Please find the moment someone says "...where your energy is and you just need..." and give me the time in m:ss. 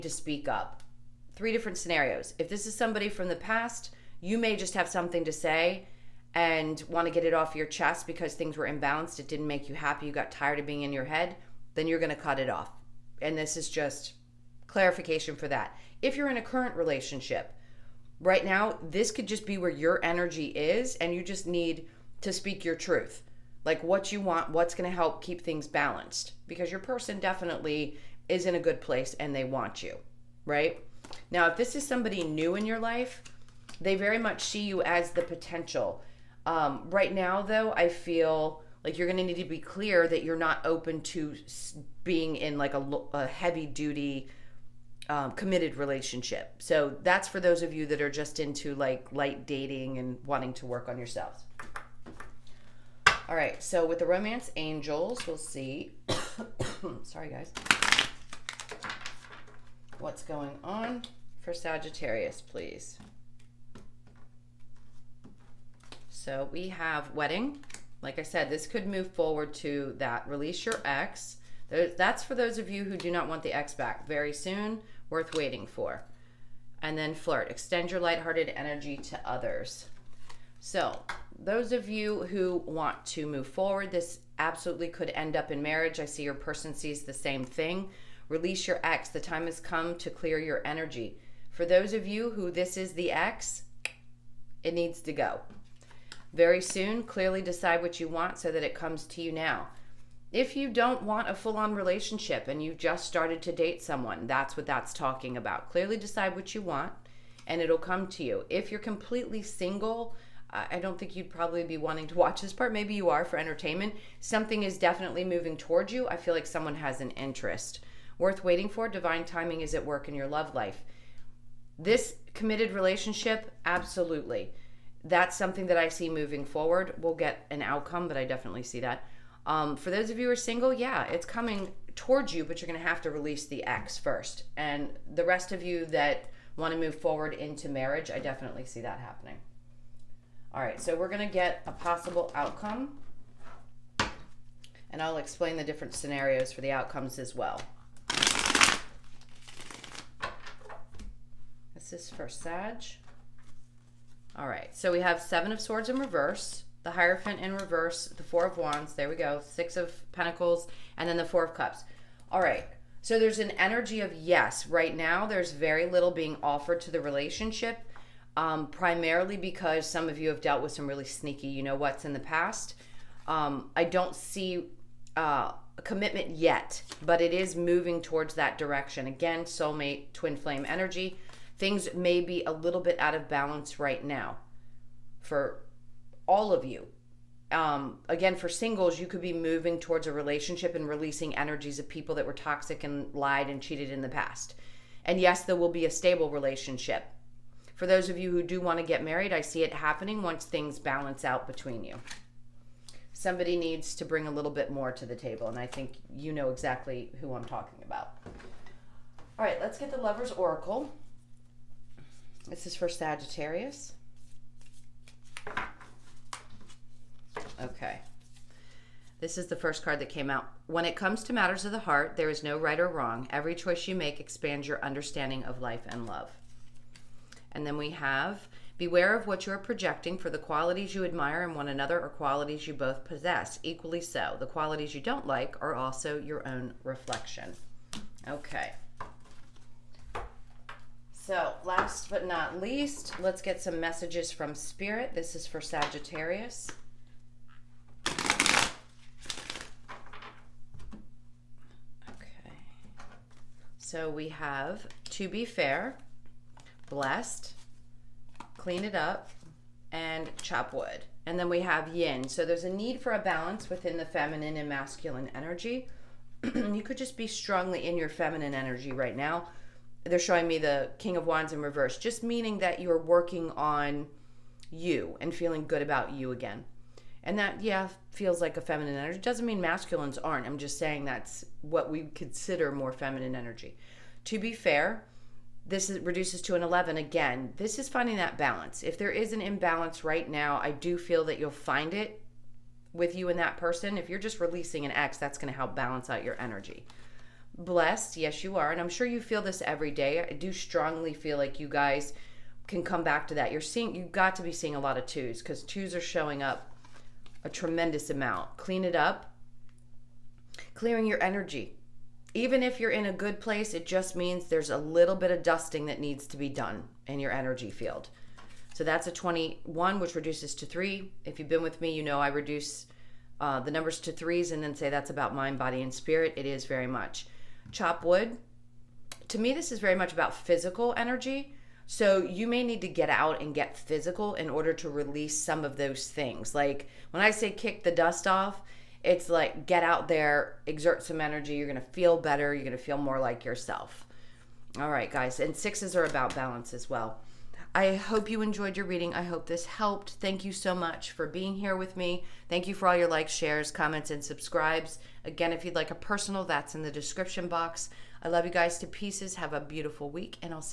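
0:19.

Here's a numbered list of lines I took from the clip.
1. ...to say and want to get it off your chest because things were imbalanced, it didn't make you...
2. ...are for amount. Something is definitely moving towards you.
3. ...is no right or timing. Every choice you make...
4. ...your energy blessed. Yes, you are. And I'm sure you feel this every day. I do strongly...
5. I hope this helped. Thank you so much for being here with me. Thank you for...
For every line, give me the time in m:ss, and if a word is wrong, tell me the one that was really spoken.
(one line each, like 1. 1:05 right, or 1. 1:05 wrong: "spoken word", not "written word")
1. 0:05 right
2. 1:53 wrong: "entertainment", not "amount"
3. 3:42 wrong: "wrong", not "timing"
4. 4:56 right
5. 5:49 right.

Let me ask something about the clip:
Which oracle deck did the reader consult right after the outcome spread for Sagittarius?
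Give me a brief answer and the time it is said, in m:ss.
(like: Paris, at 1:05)
Lover's Oracle, at 3:29.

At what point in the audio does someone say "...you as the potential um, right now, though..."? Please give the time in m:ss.
0:34.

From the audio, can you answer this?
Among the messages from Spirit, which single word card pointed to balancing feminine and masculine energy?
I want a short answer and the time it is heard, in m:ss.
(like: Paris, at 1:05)
Yin, at 4:21.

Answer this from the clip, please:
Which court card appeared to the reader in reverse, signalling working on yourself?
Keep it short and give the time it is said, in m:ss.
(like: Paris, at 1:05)
King of Wands, at 4:30.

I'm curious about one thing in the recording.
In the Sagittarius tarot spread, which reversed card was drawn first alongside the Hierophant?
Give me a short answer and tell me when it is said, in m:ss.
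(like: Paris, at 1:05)
Seven of swords, at 2:35.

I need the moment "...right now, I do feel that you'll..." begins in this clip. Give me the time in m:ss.
4:50.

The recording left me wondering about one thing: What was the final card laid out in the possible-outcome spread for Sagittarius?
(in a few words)
Four of cups.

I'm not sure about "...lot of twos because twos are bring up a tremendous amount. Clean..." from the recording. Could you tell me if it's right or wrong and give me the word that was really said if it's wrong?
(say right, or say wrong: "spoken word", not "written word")
wrong: "showing", not "bring".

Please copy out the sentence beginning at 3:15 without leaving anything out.
And yes, there will be a stable relationship.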